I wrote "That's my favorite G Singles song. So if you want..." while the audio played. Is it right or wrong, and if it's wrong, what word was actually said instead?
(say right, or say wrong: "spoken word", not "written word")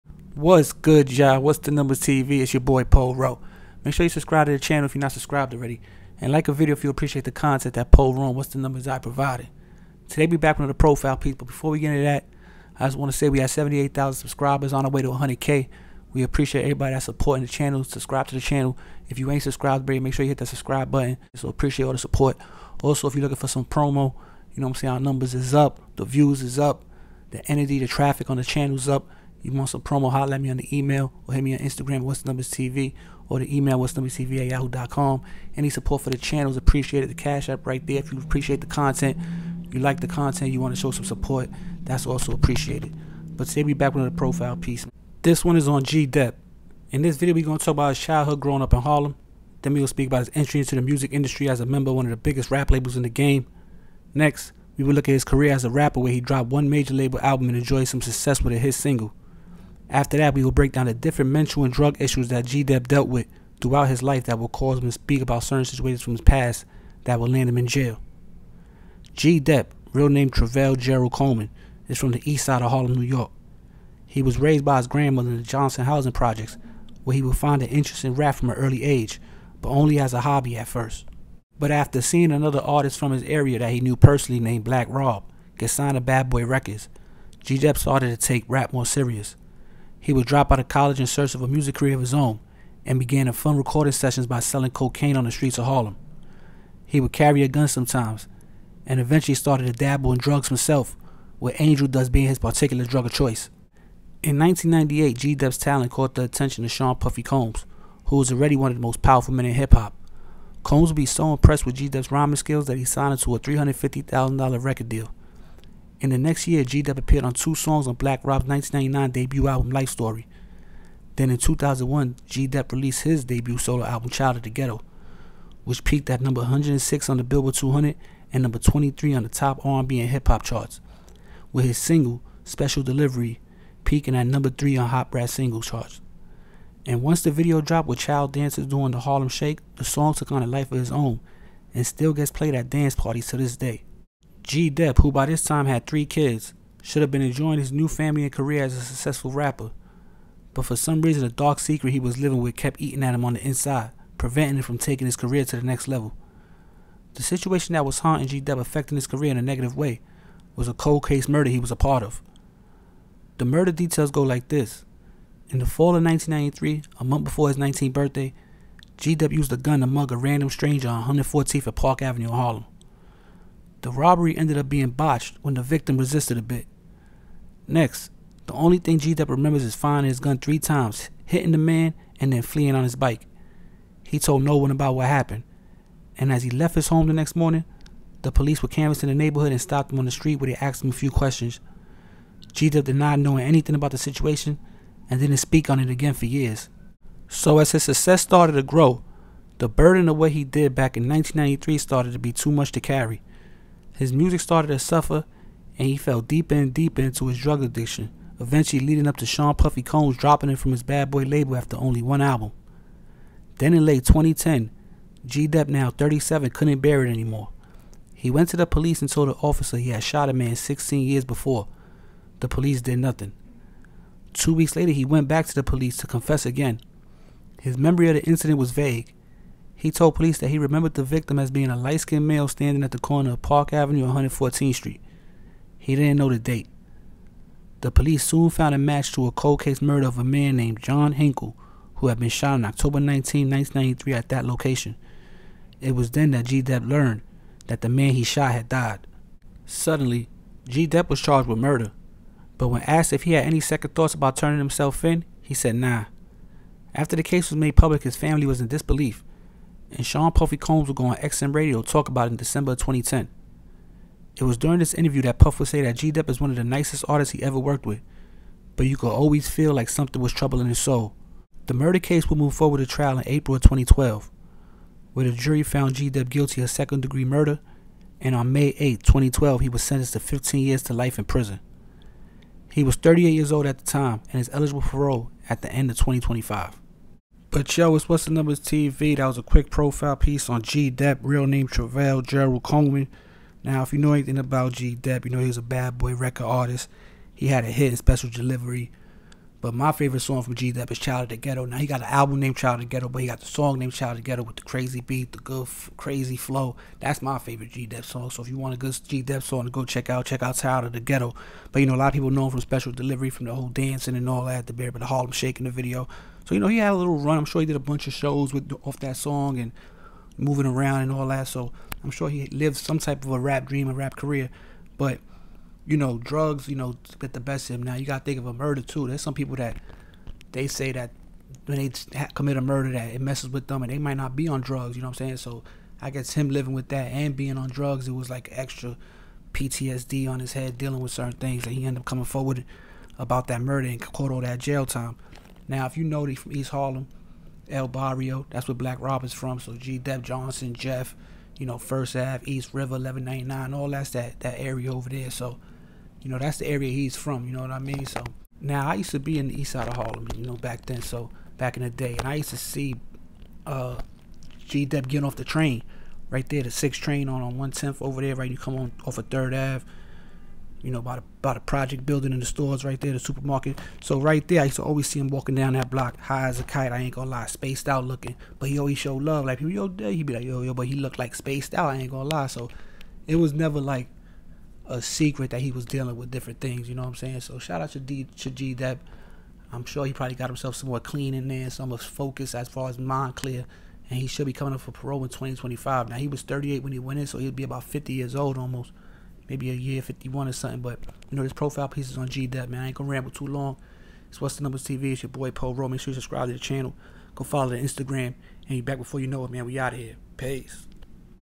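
wrong: "Dep", not "Singles".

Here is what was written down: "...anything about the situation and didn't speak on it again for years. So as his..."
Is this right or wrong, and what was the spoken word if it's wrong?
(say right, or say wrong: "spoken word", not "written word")
right.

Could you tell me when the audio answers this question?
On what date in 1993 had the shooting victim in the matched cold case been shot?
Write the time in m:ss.
4:02.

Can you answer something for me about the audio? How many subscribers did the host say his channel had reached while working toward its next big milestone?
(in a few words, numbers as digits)
78,000.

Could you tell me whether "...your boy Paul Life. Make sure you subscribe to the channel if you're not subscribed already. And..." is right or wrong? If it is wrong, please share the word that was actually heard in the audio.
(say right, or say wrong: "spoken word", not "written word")
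wrong: "Rowe", not "Life".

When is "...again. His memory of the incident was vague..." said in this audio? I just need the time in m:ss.
3:46.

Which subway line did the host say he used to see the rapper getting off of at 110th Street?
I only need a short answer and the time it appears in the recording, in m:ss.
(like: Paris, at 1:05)
6 train, at 6:06.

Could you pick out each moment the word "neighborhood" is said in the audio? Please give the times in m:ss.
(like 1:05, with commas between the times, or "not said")
3:09.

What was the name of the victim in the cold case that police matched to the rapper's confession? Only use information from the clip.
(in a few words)
John Henkel.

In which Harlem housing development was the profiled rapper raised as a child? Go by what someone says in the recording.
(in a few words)
Johnson Housing Projects.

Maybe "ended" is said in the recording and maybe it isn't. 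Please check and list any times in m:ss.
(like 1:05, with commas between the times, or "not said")
2:54, 5:41.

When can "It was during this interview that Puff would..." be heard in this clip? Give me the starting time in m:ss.
4:24.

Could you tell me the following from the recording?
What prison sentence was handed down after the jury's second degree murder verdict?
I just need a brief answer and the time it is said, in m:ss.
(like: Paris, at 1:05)
15 years to life, at 4:40.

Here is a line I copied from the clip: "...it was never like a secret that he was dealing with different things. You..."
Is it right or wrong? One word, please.
right.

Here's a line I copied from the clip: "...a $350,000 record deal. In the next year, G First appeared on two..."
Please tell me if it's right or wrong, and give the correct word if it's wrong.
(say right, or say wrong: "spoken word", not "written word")
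wrong: "Dep", not "First".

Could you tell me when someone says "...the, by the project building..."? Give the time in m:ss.
6:11.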